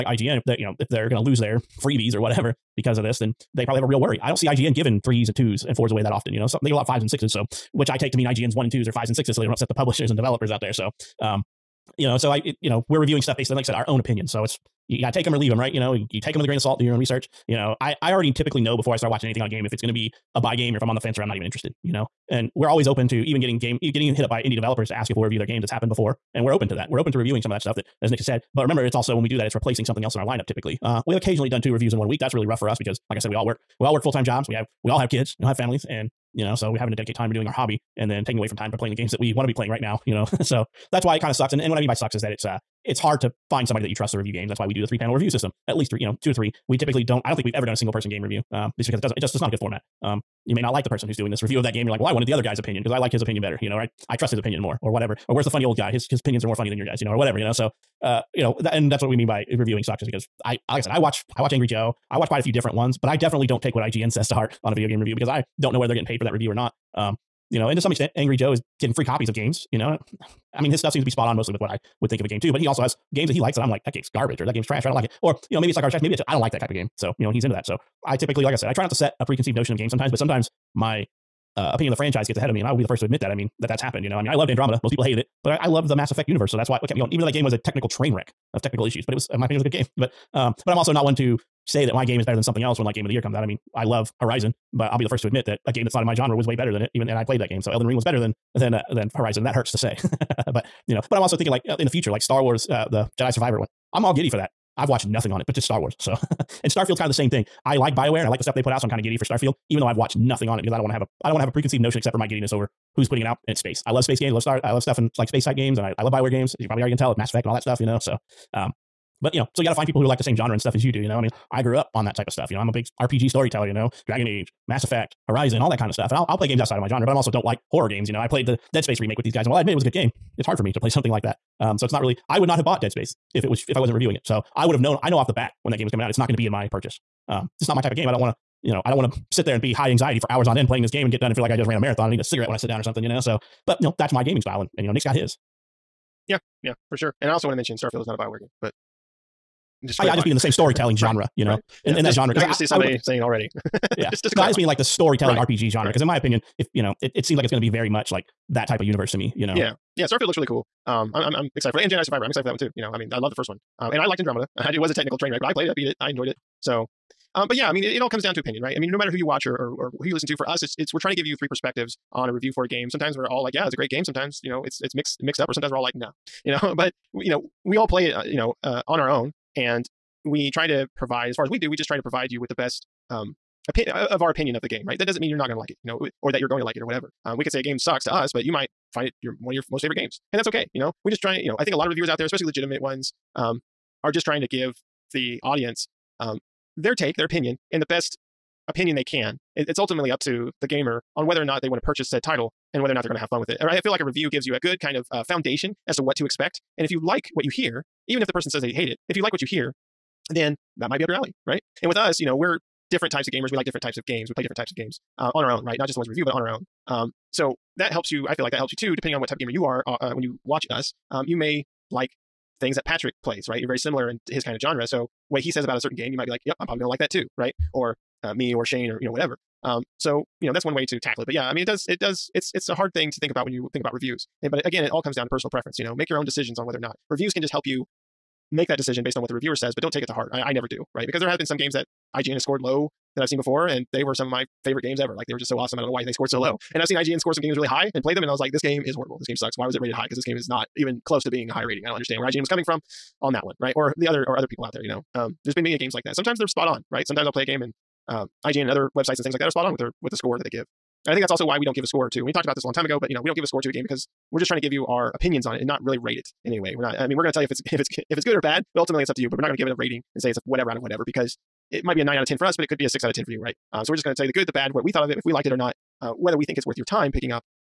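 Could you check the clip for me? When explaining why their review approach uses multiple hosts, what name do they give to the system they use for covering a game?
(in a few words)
three panel review system.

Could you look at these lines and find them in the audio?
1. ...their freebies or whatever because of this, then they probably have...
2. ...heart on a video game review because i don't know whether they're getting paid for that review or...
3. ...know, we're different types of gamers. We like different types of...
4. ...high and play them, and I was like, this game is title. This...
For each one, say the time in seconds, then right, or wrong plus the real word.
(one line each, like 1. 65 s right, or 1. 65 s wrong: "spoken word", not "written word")
1. 1 s right
2. 64 s right
3. 212 s right
4. 247 s wrong: "horrible", not "title".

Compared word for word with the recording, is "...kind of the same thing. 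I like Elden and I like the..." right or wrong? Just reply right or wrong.
wrong.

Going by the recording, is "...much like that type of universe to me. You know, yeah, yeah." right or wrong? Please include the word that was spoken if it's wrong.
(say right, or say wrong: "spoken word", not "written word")
right.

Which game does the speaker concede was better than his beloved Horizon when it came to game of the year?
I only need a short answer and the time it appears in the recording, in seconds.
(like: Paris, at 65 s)
Elden Ring, at 97 s.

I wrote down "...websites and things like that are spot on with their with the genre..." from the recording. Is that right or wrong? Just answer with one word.
wrong.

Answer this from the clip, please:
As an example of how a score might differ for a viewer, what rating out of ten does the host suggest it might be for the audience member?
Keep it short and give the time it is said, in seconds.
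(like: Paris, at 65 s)
6 out of 10, at 272 s.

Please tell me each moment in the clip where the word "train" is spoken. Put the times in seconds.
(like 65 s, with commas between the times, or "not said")
87 s, 165 s.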